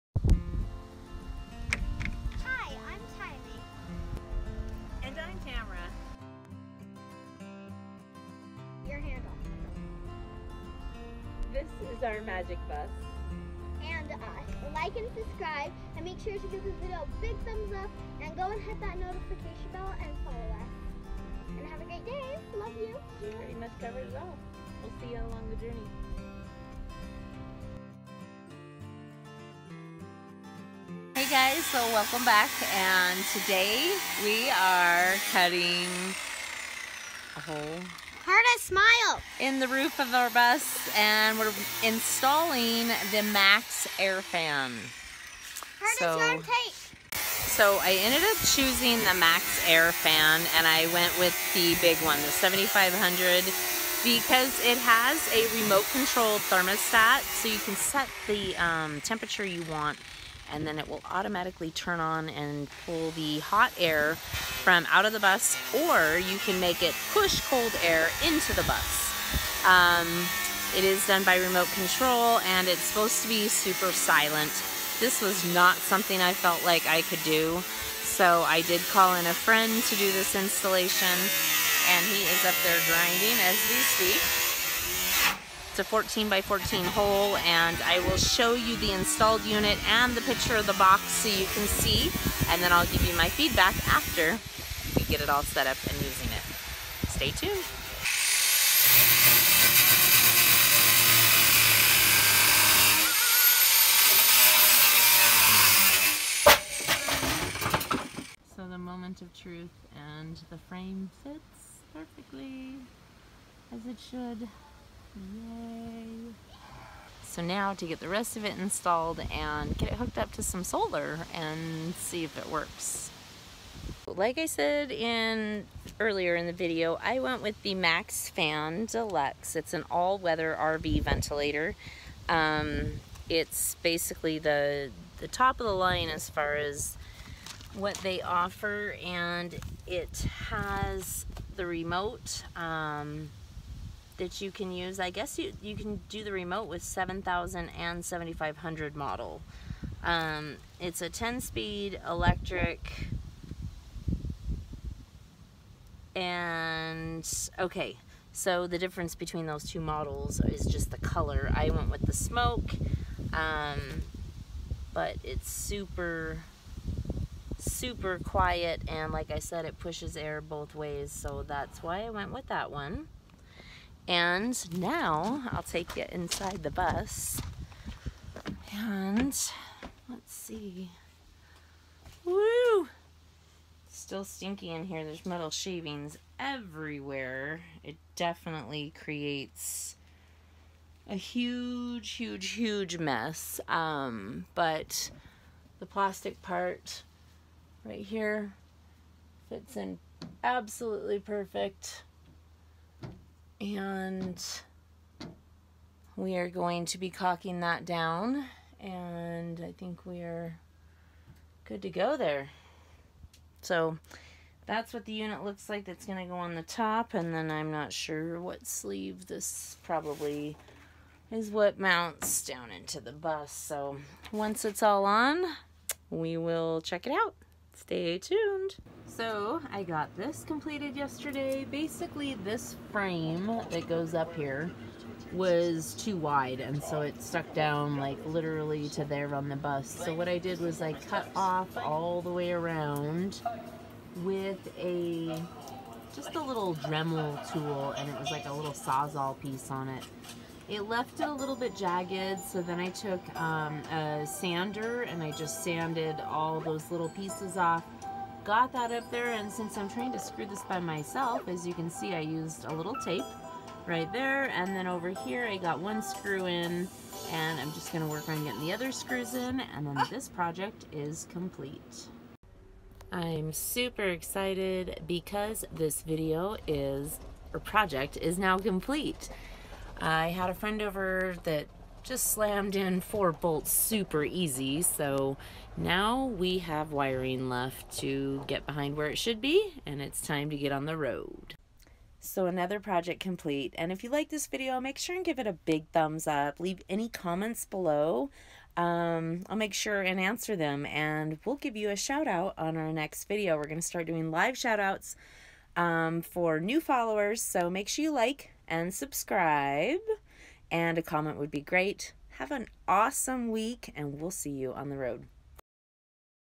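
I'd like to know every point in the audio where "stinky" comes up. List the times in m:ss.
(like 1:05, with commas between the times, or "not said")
3:04.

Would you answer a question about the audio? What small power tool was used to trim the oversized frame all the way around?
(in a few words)
Dremel.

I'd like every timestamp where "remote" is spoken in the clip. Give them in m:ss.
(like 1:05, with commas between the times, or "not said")
0:55, 1:11, 2:21, 2:26.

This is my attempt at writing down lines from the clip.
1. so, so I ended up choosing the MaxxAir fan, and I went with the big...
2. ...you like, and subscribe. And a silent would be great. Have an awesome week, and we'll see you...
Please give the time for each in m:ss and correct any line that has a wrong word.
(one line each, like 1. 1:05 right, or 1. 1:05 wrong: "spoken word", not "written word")
1. 0:45 right
2. 5:08 wrong: "comment", not "silent".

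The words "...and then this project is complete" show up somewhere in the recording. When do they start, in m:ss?
4:29.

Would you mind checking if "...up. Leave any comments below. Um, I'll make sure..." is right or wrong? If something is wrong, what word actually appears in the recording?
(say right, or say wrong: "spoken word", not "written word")
right.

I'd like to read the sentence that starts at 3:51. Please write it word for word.
Basically this frame that goes up here was too wide and so it stuck down like literally to there on the bus.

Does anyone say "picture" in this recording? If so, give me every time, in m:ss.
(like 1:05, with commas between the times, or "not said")
1:30.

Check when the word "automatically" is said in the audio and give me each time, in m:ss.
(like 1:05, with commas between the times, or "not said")
1:01.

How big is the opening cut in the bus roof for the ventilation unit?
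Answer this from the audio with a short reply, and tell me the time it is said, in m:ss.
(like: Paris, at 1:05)
14 by 14, at 1:25.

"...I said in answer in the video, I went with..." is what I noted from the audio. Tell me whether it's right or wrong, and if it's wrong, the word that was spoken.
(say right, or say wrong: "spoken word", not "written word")
wrong: "earlier", not "answer".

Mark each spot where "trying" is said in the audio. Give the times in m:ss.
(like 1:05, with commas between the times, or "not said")
4:19.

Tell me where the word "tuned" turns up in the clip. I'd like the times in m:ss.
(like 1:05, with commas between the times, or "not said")
1:37, 3:48.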